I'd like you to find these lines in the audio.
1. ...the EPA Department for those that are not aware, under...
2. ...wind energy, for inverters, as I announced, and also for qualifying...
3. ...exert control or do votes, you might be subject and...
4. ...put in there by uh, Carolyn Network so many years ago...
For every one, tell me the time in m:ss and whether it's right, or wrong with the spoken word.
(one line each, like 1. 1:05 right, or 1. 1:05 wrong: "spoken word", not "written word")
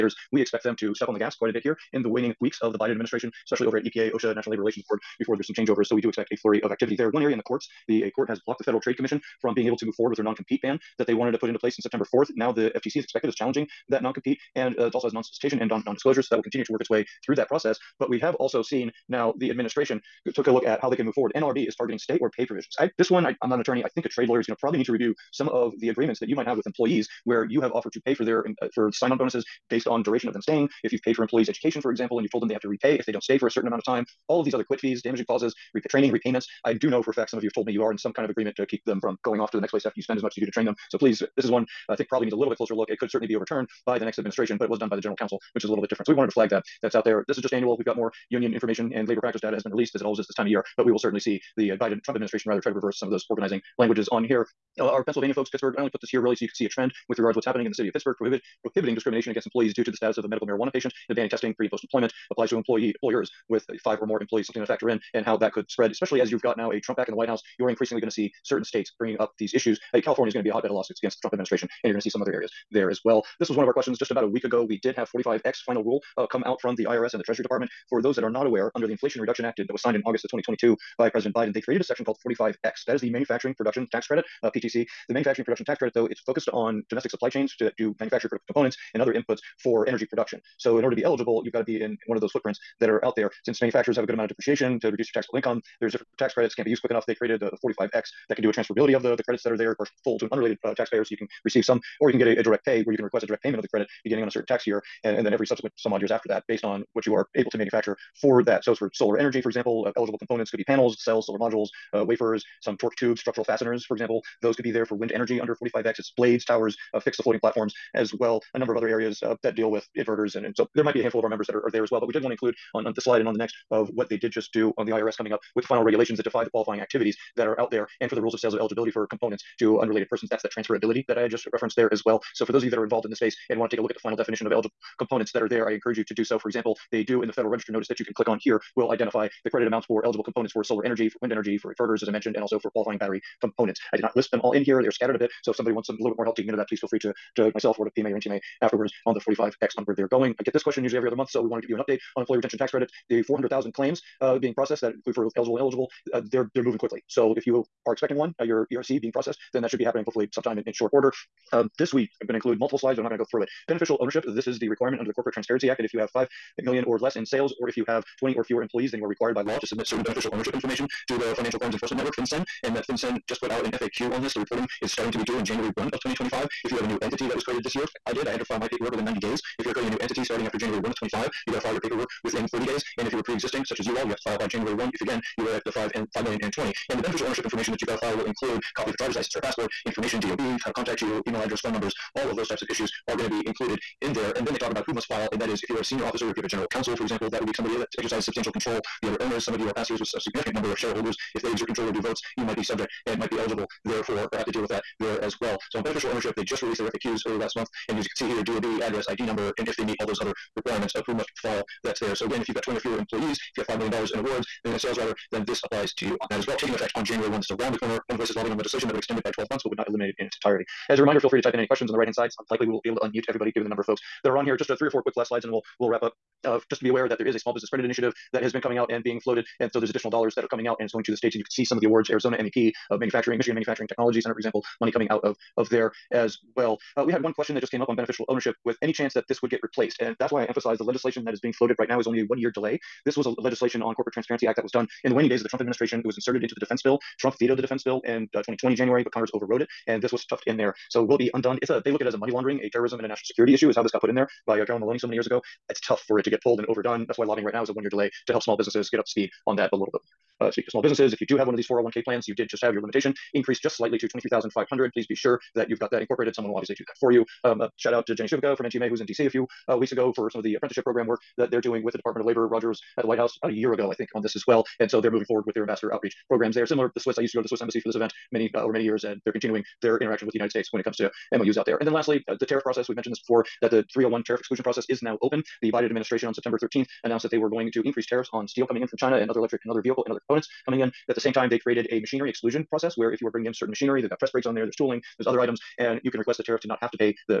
1. 1:17 wrong: "Treasury", not "EPA"
2. 2:21 wrong: "mentioned", not "announced"
3. 3:21 right
4. 4:14 wrong: "Maloney", not "Network".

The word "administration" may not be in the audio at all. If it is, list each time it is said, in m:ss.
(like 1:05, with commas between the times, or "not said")
0:02, 0:19, 0:44, 0:52, 1:11, 4:05, 4:45.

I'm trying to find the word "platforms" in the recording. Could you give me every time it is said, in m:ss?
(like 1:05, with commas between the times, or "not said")
1:57.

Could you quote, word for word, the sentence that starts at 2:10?
That's the transferability that I had just referenced there as well.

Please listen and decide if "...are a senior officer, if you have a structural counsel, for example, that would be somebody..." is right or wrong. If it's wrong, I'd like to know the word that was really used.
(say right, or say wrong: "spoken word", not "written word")
wrong: "general", not "structural".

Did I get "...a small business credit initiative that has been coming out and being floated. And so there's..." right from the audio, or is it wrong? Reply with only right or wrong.
right.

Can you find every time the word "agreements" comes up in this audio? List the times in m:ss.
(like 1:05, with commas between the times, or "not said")
0:25, 0:38.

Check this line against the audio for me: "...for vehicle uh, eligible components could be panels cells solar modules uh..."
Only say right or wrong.
wrong.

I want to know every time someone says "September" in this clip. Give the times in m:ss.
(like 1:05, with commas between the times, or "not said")
0:11, 4:46.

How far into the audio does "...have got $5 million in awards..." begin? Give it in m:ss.
3:33.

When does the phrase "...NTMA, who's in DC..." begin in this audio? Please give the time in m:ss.
4:28.